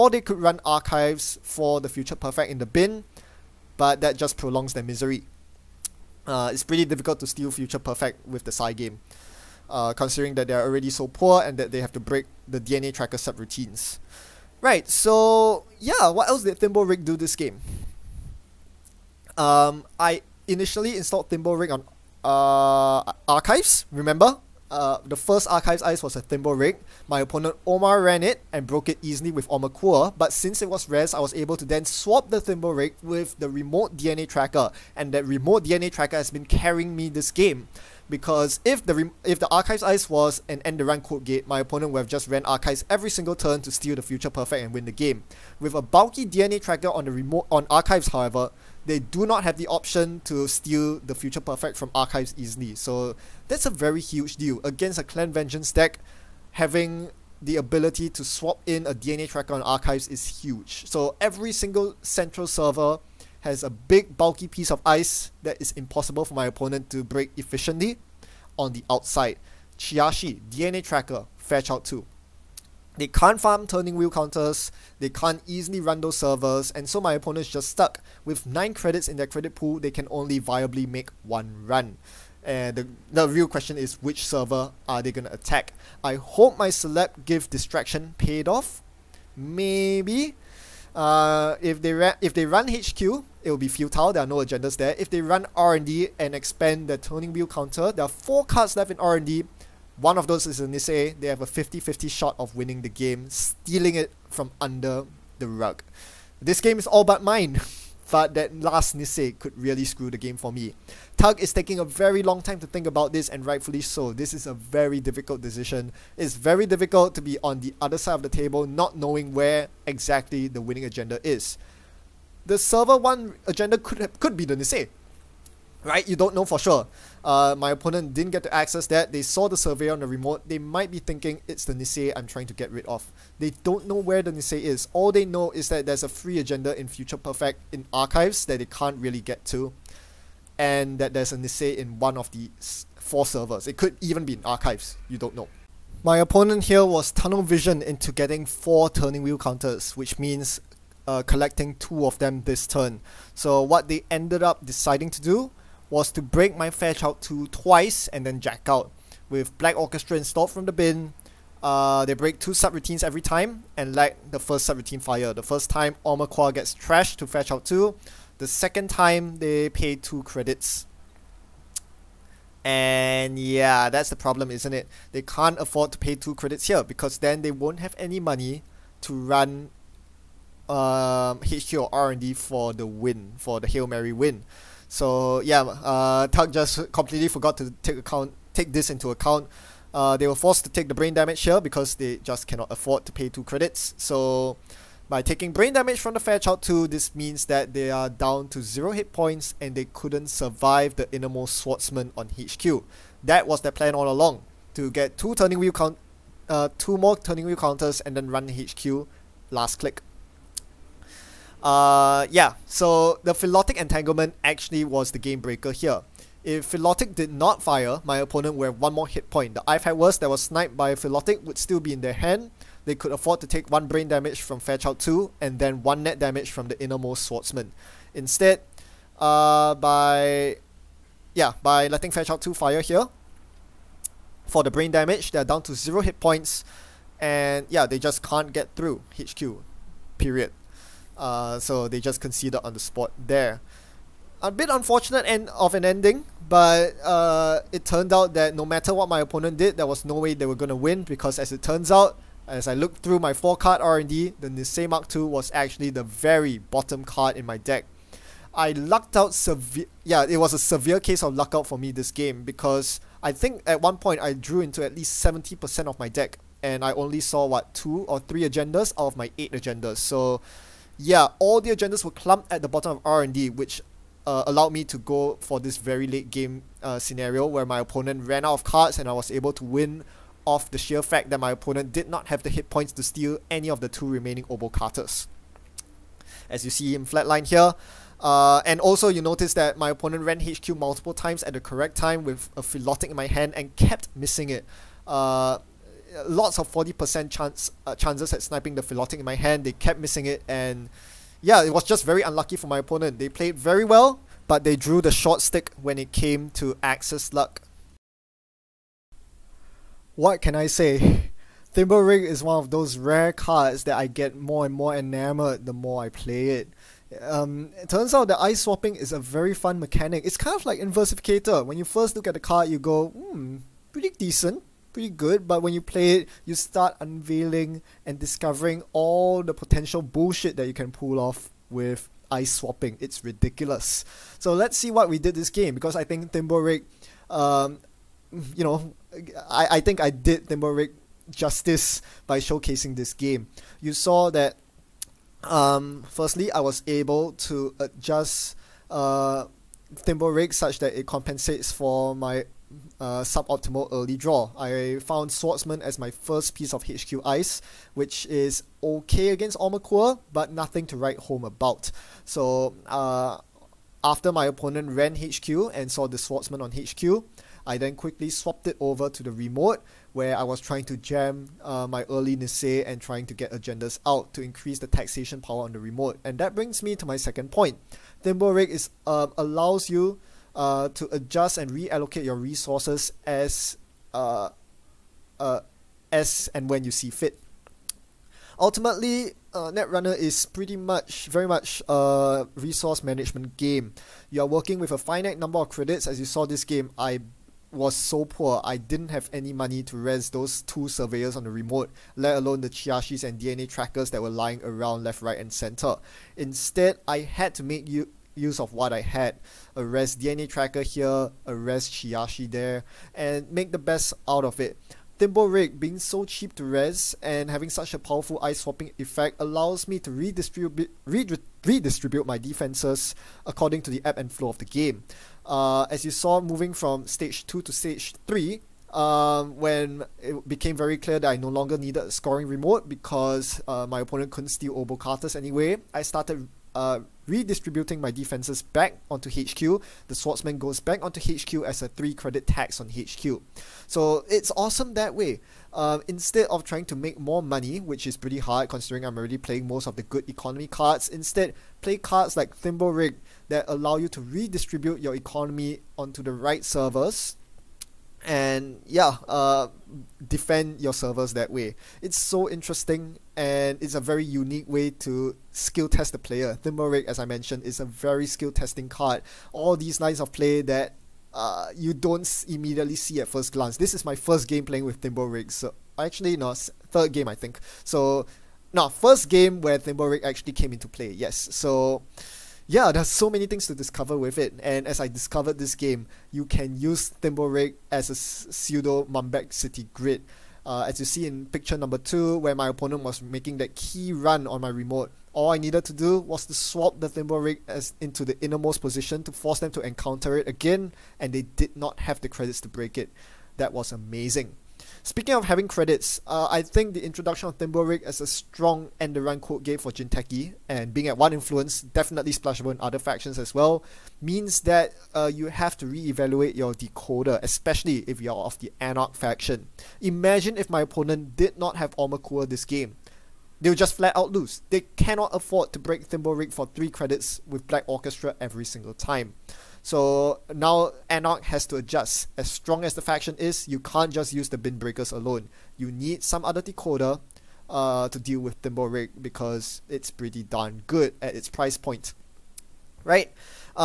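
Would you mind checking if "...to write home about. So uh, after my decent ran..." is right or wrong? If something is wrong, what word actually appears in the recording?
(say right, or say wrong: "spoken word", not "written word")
wrong: "opponent", not "decent".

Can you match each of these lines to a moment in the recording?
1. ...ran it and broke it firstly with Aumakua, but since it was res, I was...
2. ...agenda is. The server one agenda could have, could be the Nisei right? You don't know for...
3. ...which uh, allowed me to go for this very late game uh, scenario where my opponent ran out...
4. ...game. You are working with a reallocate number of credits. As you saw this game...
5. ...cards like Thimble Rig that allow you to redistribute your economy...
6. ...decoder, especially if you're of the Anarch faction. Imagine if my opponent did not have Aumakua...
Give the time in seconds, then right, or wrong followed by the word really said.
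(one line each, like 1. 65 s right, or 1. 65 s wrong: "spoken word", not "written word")
1. 28 s wrong: "easily", not "firstly"
2. 120 s right
3. 273 s right
4. 393 s wrong: "finite", not "reallocate"
5. 451 s right
6. 516 s right.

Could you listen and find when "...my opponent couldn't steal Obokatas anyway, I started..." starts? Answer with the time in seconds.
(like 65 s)
433 s.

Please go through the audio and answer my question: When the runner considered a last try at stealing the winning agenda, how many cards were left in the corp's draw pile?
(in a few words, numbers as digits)
4.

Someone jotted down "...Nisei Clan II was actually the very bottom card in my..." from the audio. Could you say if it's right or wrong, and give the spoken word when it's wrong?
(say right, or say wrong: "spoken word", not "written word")
wrong: "Mark", not "Clan".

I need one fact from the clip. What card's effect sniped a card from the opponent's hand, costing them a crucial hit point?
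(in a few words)
Philotic Entanglement.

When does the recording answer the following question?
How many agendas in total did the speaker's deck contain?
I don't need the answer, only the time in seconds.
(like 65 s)
269 s.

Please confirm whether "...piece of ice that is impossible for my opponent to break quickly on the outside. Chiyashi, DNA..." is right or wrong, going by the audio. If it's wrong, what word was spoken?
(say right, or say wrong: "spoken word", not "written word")
wrong: "efficiently", not "quickly".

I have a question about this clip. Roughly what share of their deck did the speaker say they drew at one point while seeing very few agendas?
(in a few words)
70%.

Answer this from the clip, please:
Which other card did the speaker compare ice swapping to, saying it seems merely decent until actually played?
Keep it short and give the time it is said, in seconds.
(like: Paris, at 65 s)
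Inversificator, at 320 s.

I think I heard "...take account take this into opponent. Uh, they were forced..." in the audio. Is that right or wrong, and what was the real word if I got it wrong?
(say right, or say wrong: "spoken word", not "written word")
wrong: "account", not "opponent".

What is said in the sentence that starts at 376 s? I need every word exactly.
And that brings me to my second point.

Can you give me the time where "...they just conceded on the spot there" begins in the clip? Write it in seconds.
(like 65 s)
241 s.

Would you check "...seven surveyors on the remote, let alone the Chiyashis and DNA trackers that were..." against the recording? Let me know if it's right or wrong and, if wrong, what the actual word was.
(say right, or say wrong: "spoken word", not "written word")
wrong: "two", not "seven".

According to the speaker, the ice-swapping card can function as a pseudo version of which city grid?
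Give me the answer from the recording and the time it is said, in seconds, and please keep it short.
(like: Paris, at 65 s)
Mumbad City Grid, at 489 s.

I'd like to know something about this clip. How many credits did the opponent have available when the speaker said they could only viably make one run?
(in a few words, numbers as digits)
9.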